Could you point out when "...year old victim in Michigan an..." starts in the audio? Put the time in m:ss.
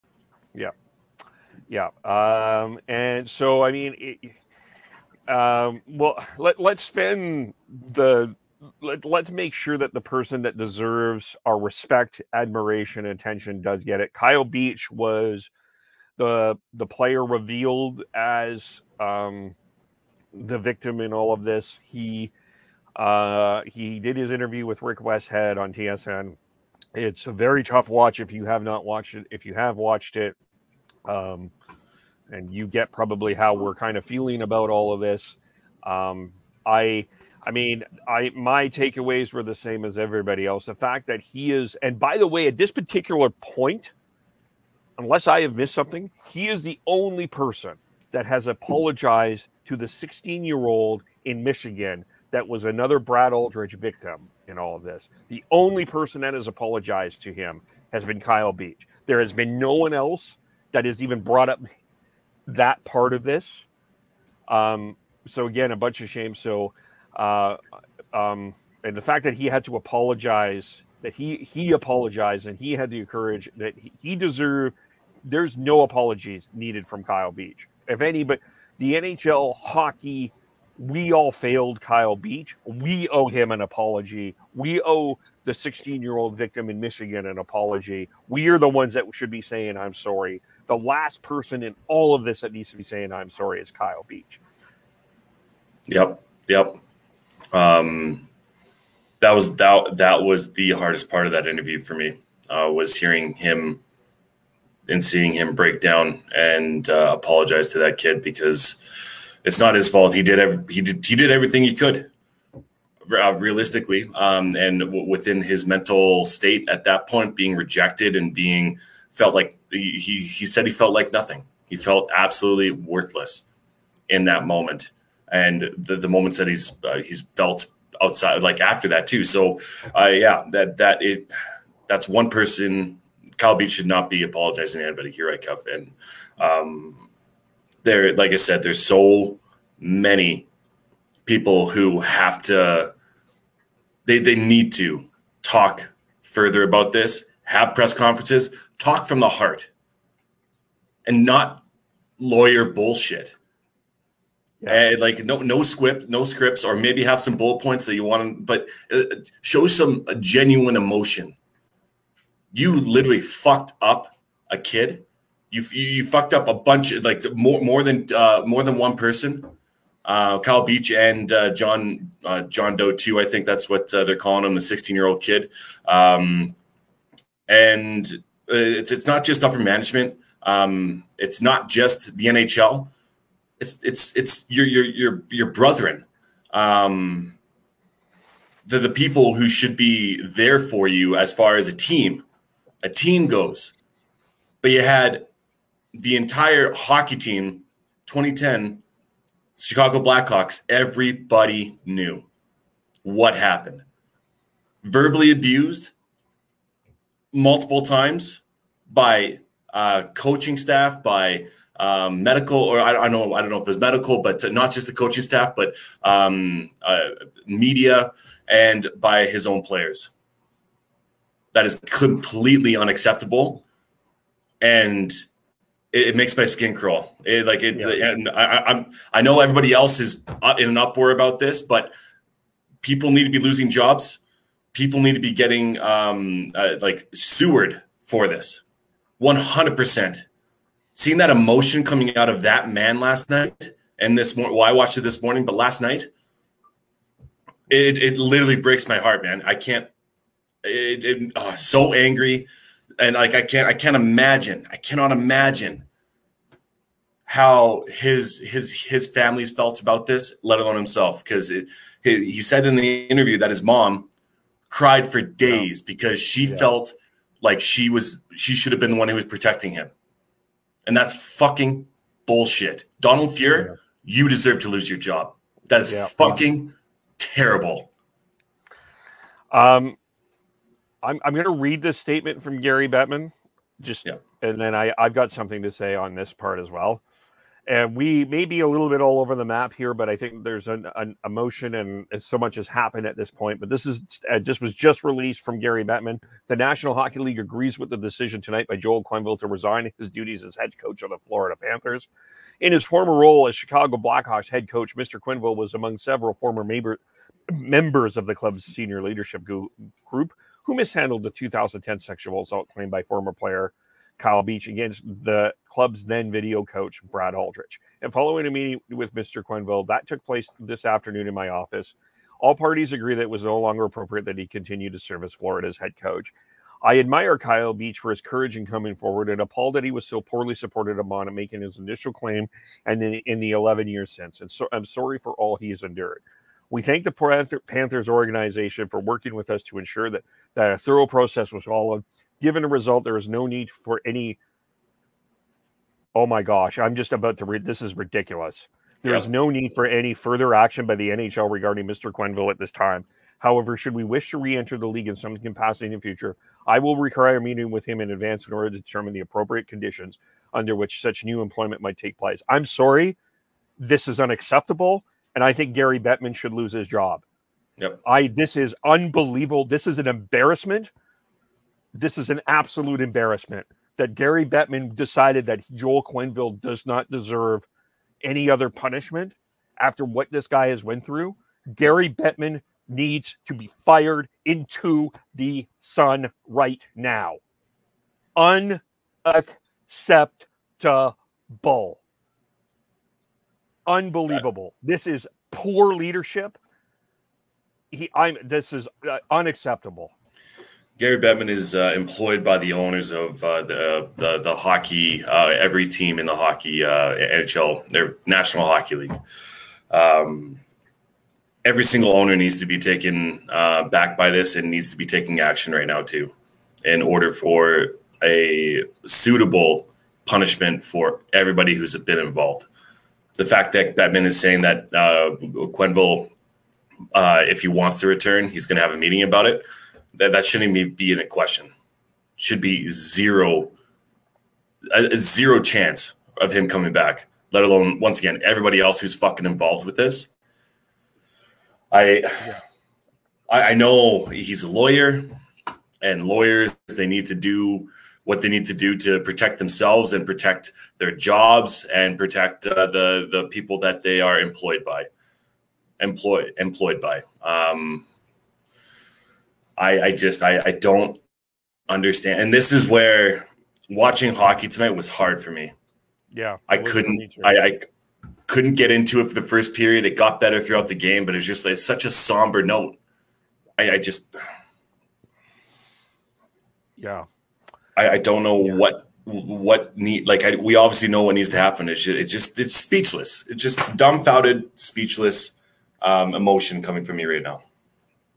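1:26.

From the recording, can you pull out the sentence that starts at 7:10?
That that shouldn't be in a question.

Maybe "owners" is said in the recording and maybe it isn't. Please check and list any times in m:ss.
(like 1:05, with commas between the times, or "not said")
6:42, 6:52.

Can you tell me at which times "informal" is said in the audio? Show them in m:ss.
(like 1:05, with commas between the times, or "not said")
not said.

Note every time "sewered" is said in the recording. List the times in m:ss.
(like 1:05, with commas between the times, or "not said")
3:57.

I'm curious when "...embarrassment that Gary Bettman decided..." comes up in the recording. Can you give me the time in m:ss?
6:13.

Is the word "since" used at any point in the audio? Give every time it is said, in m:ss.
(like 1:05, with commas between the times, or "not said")
5:34.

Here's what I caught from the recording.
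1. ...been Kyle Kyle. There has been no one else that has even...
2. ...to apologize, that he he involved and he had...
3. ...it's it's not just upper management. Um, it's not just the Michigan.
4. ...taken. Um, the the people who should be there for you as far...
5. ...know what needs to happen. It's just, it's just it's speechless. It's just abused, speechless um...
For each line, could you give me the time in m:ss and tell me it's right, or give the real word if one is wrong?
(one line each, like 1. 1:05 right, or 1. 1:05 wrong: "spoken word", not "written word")
1. 0:58 wrong: "Beach", not "Kyle"
2. 1:09 wrong: "apologized", not "involved"
3. 2:58 wrong: "NHL", not "Michigan"
4. 3:05 wrong: "brethren", not "taken"
5. 8:01 wrong: "dumbfounded", not "abused".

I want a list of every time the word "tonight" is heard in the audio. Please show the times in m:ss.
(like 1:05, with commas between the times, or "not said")
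4:58, 7:44.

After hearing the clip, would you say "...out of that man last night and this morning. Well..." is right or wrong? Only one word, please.
right.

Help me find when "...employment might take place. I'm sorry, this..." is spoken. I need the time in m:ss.
6:01.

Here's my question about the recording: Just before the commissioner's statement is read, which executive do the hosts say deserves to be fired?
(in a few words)
Donald Fuhrer.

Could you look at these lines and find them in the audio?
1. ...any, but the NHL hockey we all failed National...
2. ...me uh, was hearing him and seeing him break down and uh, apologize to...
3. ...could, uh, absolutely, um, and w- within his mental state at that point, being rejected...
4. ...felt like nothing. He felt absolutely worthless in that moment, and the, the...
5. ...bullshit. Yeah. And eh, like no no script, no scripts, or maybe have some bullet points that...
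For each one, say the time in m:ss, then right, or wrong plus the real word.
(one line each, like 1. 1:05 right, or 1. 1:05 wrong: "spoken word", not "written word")
1. 1:18 wrong: "Kyle", not "National"
2. 1:41 right
3. 1:51 wrong: "realistically", not "absolutely"
4. 2:00 right
5. 2:32 right.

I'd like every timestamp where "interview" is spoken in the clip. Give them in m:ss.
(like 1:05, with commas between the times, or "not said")
0:24, 1:41, 4:23.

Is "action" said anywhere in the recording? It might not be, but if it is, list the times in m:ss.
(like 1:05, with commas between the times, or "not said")
5:50, 6:55.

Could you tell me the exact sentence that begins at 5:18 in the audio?
And following a meeting with Mr.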